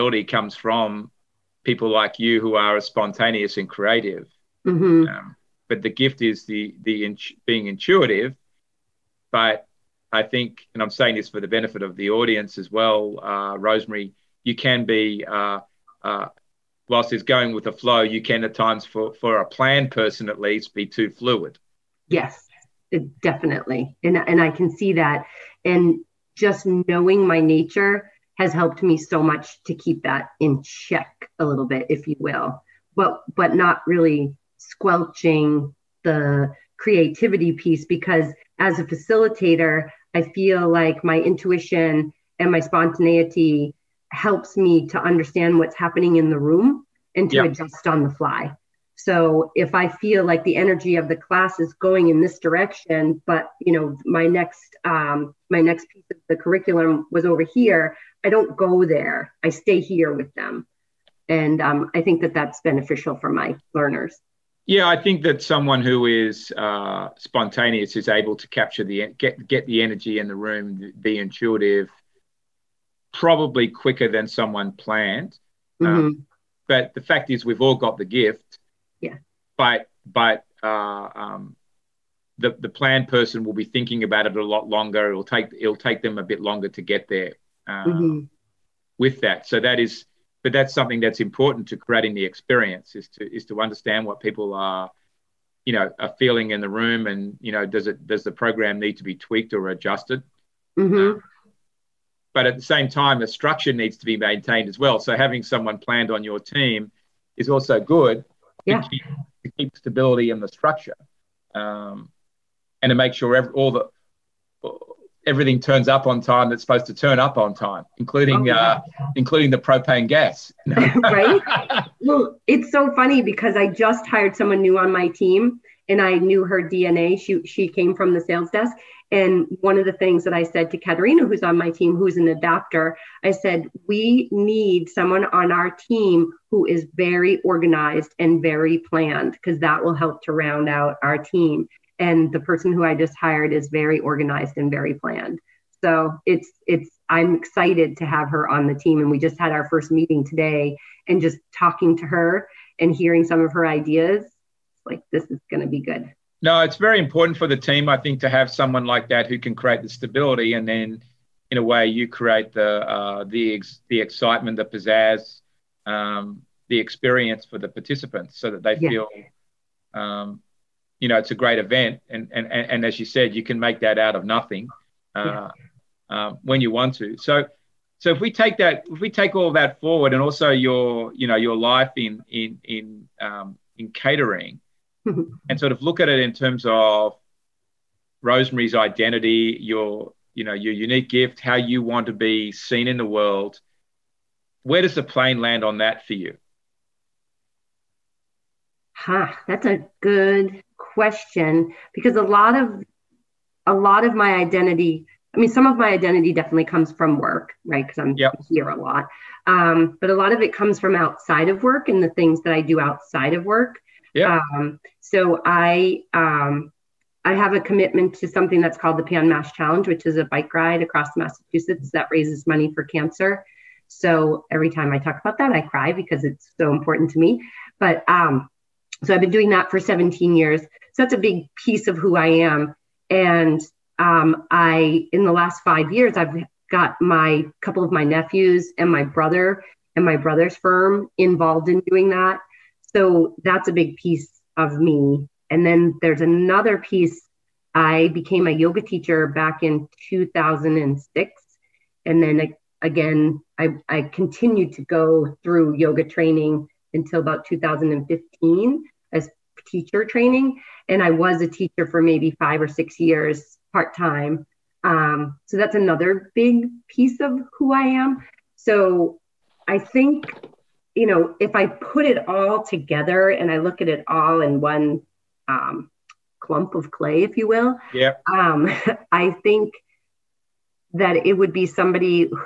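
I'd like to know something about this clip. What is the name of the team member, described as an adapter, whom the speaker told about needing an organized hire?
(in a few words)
Katerina.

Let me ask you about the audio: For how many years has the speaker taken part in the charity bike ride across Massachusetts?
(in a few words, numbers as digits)
17.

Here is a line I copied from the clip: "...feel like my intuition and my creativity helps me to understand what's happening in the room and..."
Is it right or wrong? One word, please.
wrong.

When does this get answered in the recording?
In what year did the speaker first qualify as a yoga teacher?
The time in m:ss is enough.
4:10.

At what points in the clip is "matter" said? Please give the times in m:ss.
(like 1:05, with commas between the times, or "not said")
not said.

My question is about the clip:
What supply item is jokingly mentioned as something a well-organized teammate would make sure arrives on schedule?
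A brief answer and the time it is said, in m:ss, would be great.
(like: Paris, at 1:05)
propane gas, at 1:59.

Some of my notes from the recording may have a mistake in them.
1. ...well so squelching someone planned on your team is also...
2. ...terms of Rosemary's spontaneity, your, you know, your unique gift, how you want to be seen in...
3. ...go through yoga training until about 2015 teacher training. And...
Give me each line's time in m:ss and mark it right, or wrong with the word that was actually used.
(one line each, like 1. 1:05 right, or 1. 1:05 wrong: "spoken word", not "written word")
1. 1:44 wrong: "having", not "squelching"
2. 3:06 wrong: "identity", not "spontaneity"
3. 4:14 right.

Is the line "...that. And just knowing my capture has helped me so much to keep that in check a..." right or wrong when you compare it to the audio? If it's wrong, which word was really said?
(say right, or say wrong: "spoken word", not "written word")
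wrong: "nature", not "capture".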